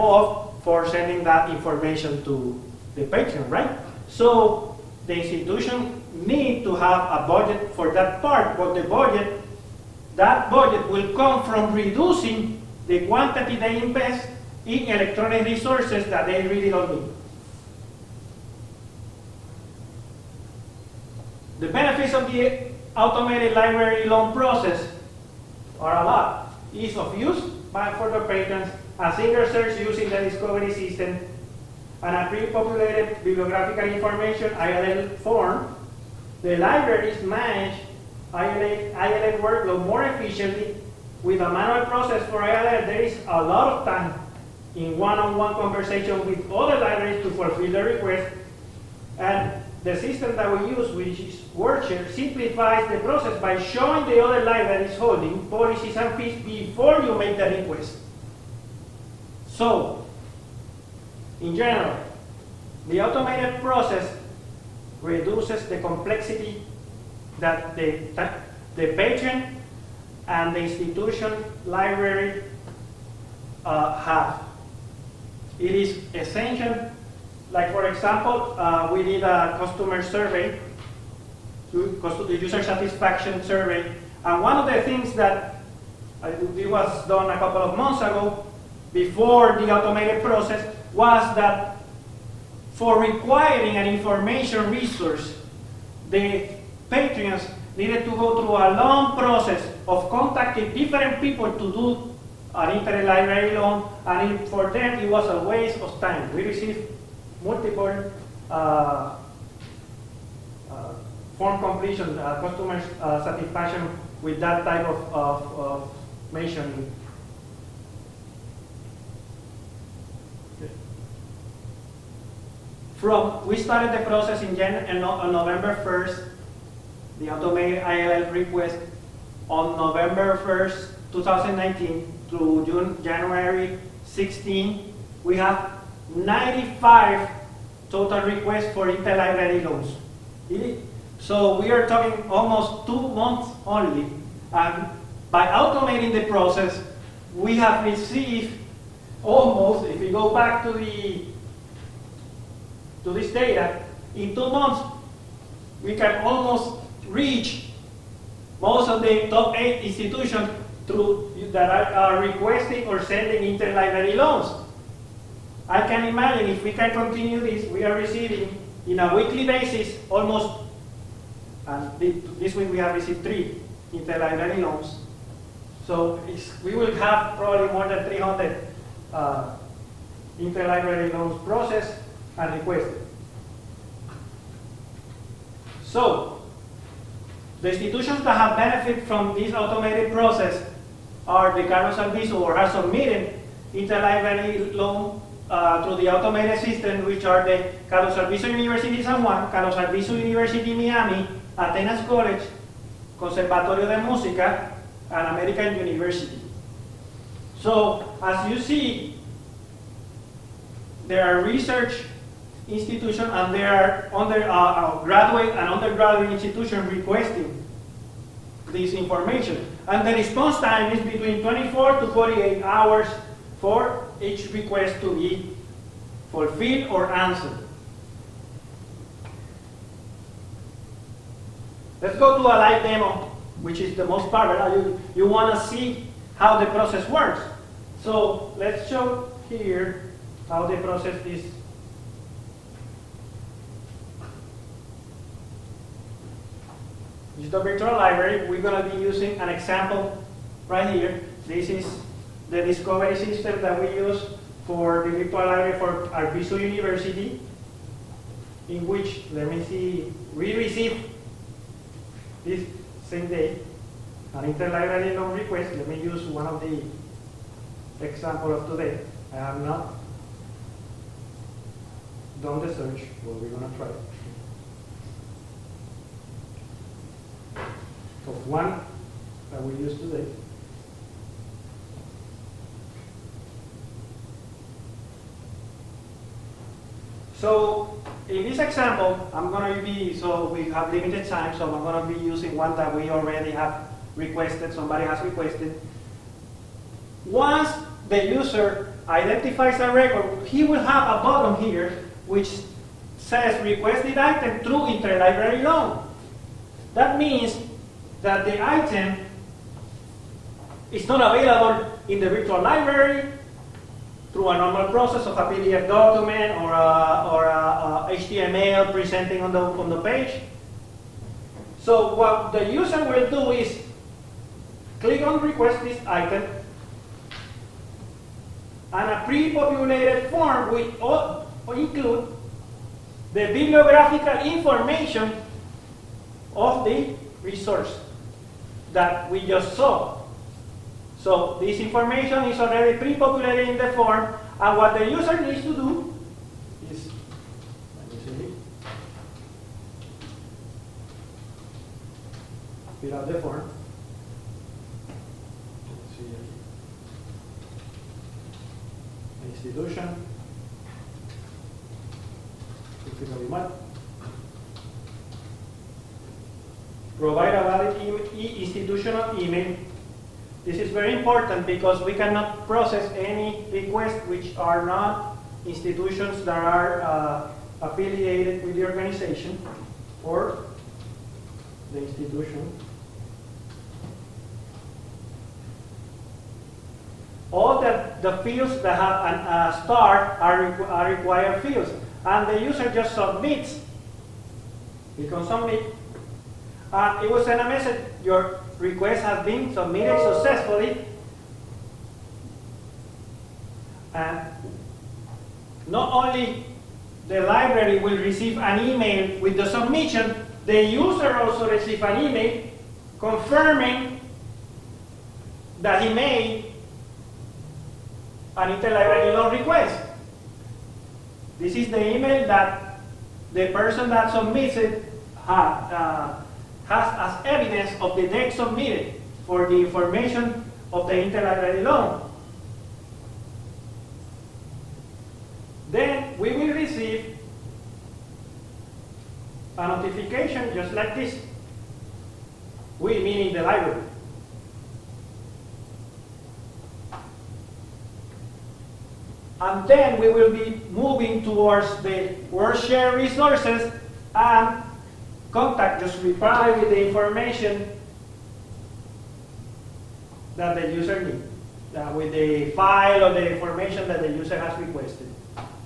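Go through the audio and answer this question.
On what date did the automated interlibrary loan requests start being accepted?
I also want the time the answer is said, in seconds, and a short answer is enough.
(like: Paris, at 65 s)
November 1, 2019, at 129 s.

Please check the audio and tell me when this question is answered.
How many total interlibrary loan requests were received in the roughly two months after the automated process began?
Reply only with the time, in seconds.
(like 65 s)
136 s.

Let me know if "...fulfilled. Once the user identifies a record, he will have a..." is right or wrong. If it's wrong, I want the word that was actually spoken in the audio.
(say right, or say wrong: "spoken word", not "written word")
wrong: "requested", not "fulfilled".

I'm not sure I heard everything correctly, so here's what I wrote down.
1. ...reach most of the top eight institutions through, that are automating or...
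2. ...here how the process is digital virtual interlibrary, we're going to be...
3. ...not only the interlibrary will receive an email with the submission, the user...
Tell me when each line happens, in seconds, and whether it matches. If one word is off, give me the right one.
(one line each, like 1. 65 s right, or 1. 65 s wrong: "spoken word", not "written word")
1. 157 s wrong: "requesting", not "automating"
2. 239 s wrong: "library", not "interlibrary"
3. 405 s wrong: "library", not "interlibrary".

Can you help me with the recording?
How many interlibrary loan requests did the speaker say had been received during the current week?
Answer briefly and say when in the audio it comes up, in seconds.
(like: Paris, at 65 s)
3, at 173 s.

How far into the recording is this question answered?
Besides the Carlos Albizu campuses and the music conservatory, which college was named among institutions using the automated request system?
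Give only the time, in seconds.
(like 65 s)
201 s.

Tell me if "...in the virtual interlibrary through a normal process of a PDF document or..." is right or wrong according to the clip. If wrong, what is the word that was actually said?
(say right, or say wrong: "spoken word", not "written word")
wrong: "library", not "interlibrary".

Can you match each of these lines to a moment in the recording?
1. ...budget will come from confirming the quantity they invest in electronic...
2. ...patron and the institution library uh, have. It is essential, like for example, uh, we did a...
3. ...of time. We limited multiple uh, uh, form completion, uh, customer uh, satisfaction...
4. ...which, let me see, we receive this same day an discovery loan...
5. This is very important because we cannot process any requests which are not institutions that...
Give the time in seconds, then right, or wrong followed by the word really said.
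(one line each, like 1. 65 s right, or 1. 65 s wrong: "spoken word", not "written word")
1. 10 s wrong: "reducing", not "confirming"
2. 68 s right
3. 105 s wrong: "received", not "limited"
4. 258 s wrong: "interlibrary", not "discovery"
5. 370 s right.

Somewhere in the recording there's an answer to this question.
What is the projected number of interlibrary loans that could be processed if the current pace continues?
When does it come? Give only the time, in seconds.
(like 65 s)
177 s.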